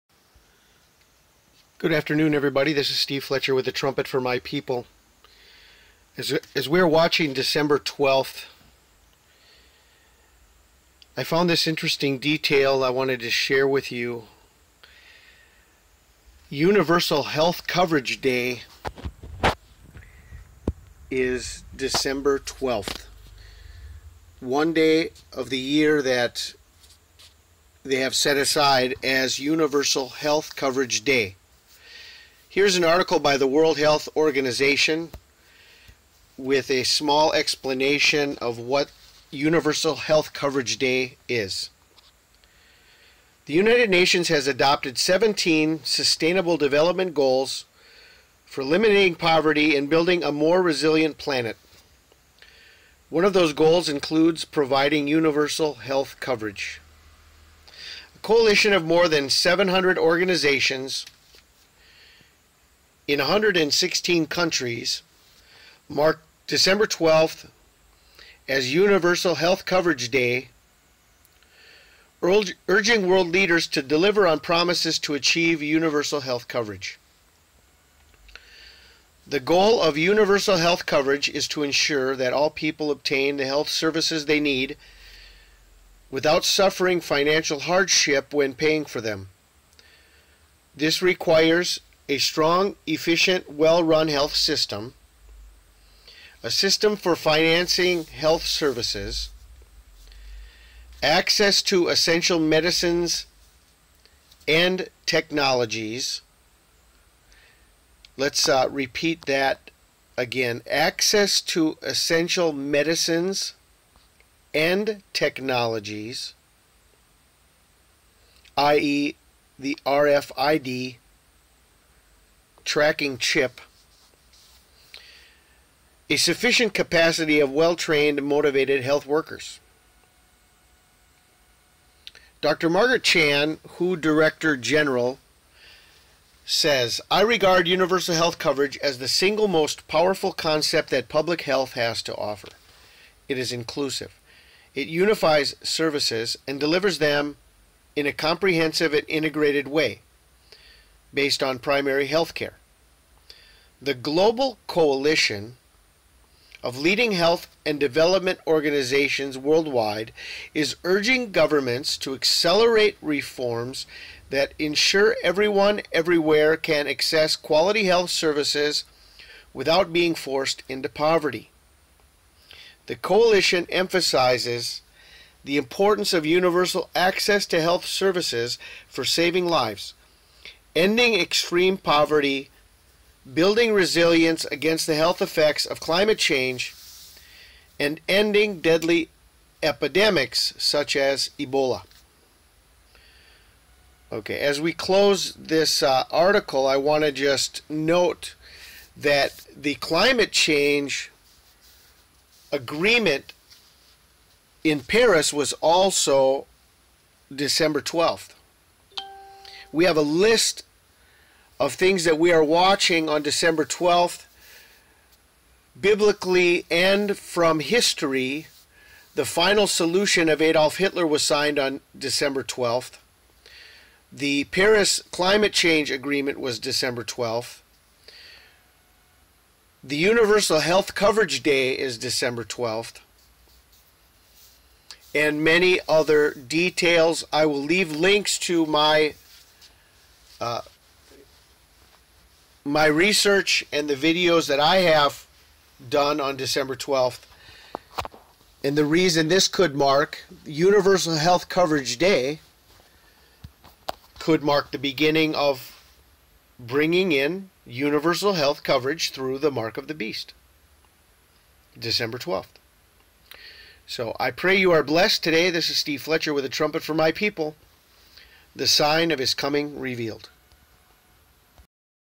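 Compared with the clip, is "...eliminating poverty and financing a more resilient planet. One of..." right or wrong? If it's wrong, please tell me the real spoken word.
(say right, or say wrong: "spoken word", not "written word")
wrong: "building", not "financing".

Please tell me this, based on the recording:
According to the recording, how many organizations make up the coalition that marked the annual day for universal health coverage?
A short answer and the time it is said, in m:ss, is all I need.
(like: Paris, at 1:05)
more than 700, at 0:58.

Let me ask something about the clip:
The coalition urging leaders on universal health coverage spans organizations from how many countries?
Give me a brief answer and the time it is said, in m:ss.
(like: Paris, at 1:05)
116, at 1:03.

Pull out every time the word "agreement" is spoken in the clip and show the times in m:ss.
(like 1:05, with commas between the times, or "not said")
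3:22, 3:45.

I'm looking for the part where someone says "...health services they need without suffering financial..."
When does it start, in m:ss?
1:23.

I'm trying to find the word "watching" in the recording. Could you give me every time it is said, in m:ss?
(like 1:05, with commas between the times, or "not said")
0:06, 3:32.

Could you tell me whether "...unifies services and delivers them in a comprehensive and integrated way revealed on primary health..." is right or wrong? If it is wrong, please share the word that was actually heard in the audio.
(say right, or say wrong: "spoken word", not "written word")
wrong: "based", not "revealed".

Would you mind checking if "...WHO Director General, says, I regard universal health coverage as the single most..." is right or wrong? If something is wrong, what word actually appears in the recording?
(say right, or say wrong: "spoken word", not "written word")
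right.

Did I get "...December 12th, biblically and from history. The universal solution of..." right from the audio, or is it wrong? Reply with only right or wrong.
wrong.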